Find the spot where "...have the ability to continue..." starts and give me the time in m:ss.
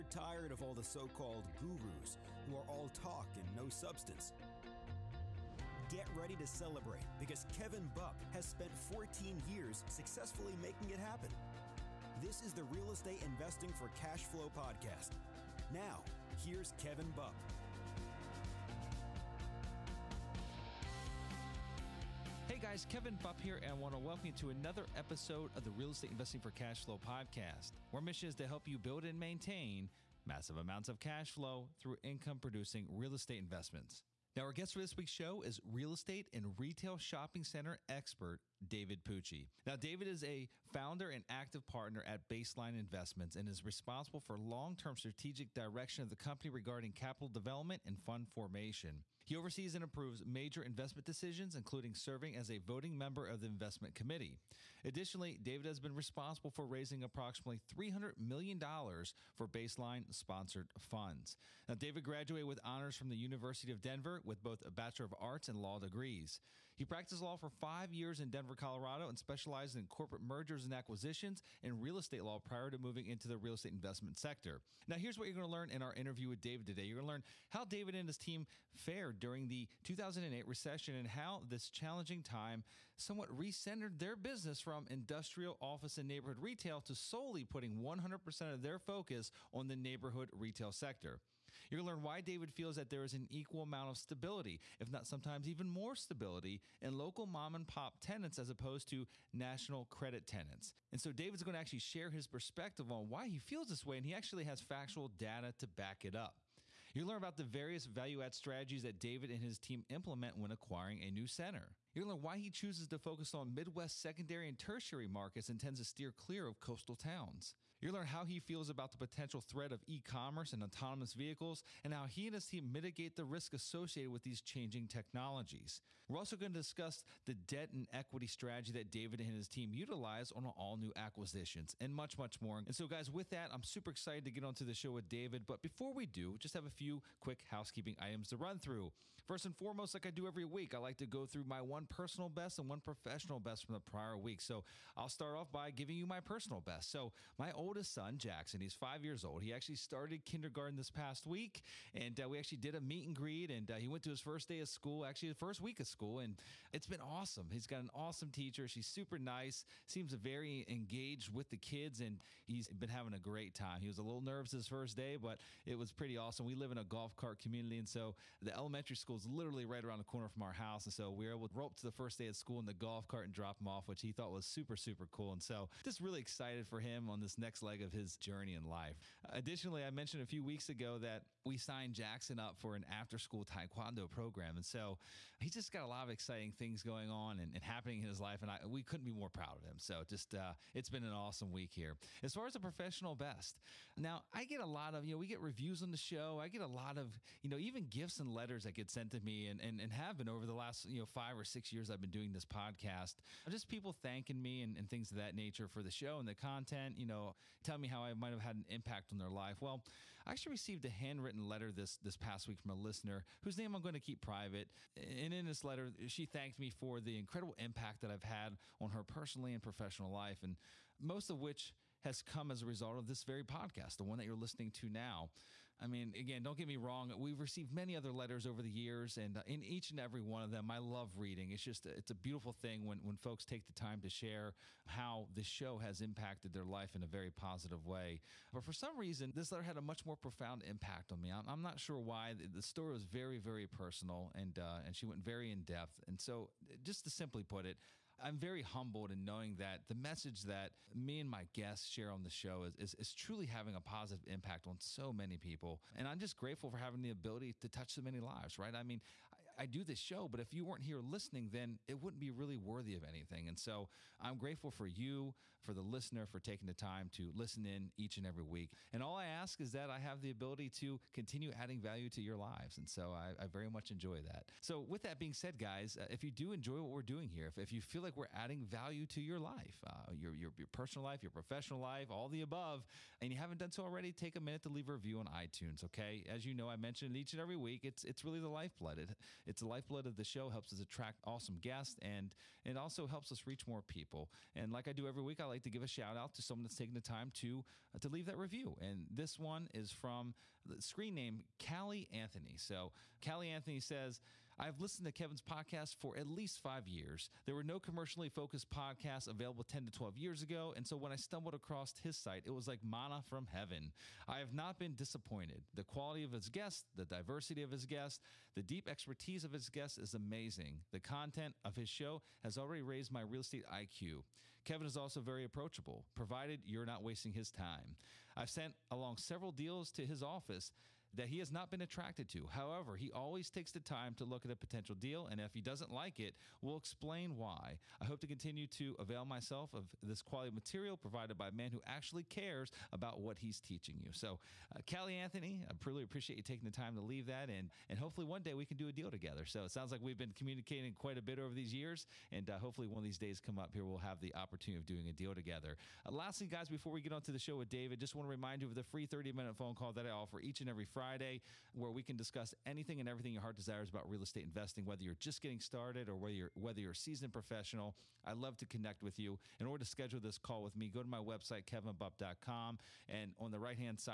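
4:29.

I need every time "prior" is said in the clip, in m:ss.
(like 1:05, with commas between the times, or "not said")
1:12, 2:23.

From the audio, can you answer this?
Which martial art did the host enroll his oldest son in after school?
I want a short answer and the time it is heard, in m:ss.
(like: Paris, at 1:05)
taekwondo, at 3:03.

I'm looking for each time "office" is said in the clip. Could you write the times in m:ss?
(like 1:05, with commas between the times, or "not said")
1:25, 5:30.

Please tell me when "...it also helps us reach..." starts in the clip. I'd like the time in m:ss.
4:52.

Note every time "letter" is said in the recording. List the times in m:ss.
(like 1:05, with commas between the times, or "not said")
3:18, 3:31, 3:35, 3:48, 3:59.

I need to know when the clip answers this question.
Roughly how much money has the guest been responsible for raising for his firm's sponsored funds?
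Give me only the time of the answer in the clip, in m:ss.
0:57.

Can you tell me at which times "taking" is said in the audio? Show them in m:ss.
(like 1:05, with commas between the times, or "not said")
4:26, 4:56, 5:46.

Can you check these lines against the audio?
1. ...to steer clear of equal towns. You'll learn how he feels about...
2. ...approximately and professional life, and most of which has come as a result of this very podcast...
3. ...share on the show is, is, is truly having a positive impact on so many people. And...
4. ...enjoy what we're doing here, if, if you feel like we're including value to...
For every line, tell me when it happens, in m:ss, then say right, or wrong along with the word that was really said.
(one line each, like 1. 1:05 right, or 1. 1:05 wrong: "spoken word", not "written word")
1. 1:55 wrong: "coastal", not "equal"
2. 3:39 wrong: "personally", not "approximately"
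3. 4:11 right
4. 4:36 wrong: "adding", not "including".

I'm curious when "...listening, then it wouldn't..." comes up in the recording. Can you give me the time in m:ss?
4:20.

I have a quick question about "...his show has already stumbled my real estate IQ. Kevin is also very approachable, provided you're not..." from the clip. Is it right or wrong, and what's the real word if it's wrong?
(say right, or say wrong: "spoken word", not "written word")
wrong: "raised", not "stumbled".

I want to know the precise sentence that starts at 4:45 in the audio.
Okay, as you know, I mentioned each and every week.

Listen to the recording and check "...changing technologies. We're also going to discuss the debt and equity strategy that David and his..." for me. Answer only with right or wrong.
right.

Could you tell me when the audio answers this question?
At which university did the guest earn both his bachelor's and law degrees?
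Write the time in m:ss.
1:03.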